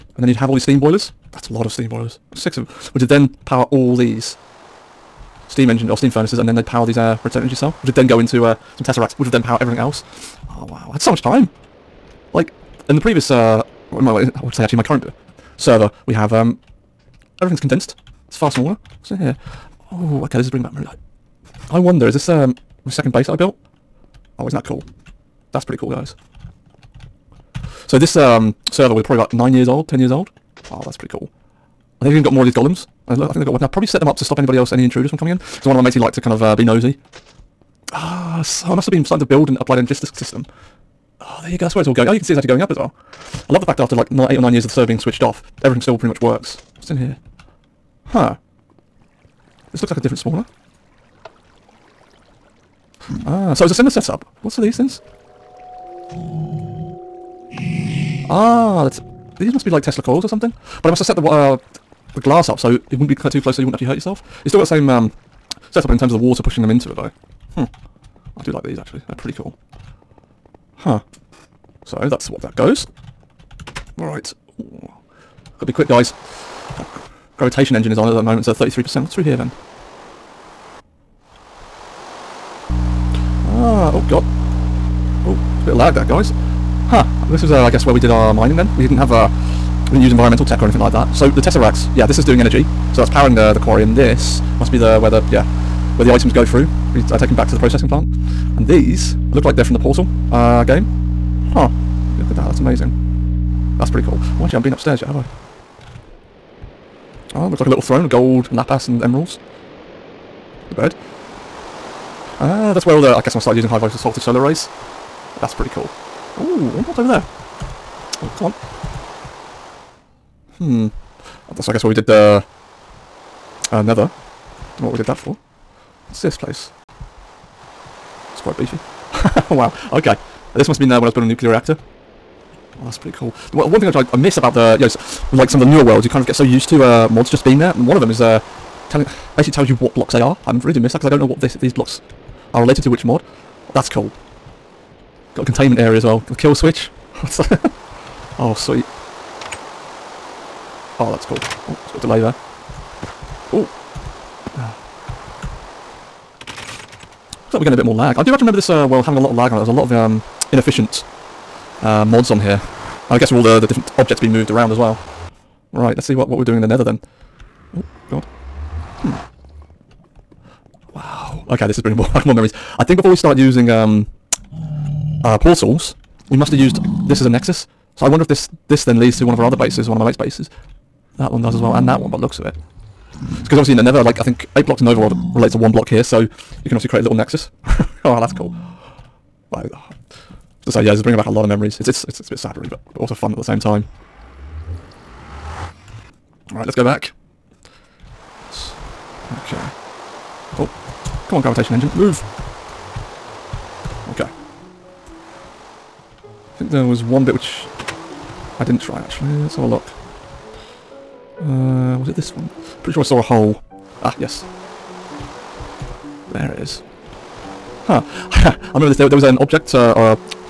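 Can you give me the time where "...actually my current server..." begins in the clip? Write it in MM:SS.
00:14.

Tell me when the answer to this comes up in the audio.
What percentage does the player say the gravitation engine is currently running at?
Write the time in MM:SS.
01:18.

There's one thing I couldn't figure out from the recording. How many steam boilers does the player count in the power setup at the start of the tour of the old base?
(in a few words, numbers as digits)
6.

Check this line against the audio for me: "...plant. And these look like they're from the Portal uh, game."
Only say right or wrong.
right.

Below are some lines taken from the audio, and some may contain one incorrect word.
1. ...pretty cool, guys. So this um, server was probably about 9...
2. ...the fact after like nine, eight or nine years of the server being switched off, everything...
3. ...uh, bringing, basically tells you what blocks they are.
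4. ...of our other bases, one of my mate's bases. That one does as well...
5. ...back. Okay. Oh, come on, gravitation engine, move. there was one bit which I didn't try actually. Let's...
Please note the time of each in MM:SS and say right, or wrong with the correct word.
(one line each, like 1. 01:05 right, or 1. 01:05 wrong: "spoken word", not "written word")
1. 00:25 right
2. 00:43 right
3. 02:18 wrong: "telling", not "bringing"
4. 02:59 right
5. 03:16 right.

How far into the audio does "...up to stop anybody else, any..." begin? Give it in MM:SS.
00:34.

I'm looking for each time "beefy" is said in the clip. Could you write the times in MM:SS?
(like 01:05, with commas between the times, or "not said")
02:08.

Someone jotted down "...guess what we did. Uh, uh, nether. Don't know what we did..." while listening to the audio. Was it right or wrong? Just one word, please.
right.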